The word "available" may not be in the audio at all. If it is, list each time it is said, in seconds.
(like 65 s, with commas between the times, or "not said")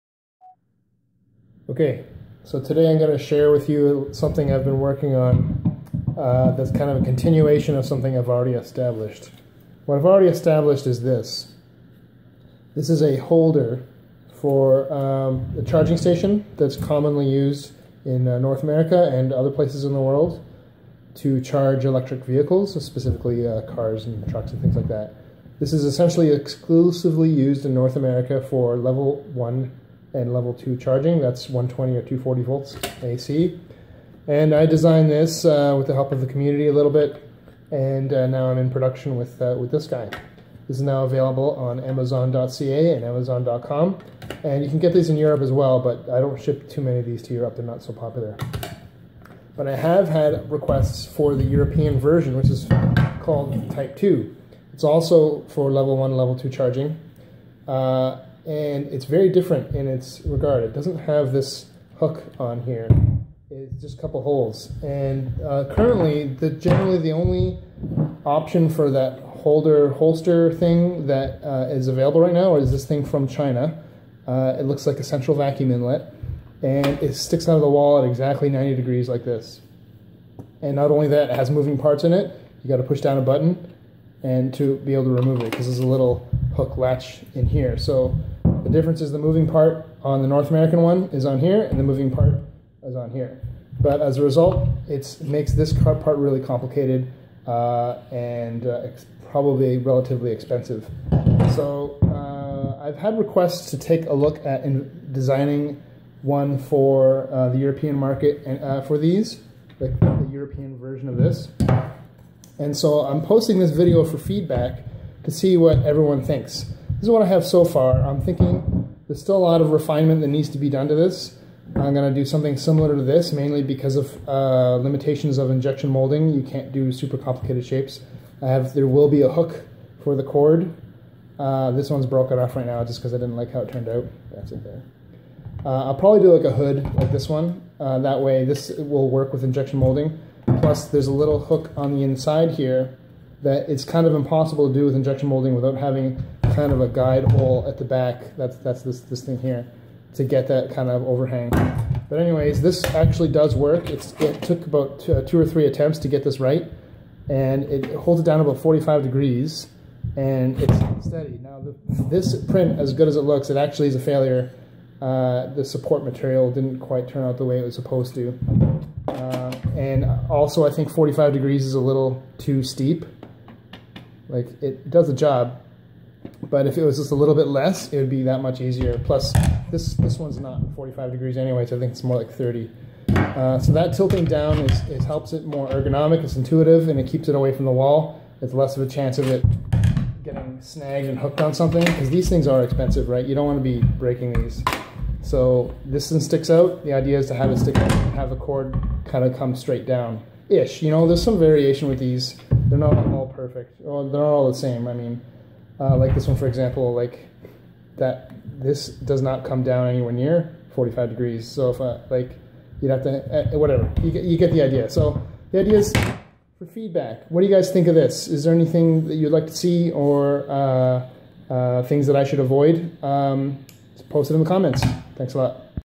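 41 s, 71 s.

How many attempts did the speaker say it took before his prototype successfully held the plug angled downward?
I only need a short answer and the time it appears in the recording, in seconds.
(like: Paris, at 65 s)
2 or 3, at 155 s.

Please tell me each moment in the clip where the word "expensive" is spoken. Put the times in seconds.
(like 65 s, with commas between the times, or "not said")
100 s, 192 s.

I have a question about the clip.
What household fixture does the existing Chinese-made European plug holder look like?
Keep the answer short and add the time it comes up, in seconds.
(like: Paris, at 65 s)
central vacuum inlet, at 75 s.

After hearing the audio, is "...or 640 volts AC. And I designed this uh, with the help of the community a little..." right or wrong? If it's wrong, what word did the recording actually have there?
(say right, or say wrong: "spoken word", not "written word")
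wrong: "240", not "640".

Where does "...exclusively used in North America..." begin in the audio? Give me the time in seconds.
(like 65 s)
26 s.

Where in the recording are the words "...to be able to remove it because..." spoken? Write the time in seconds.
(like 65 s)
84 s.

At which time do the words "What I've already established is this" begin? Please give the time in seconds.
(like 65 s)
9 s.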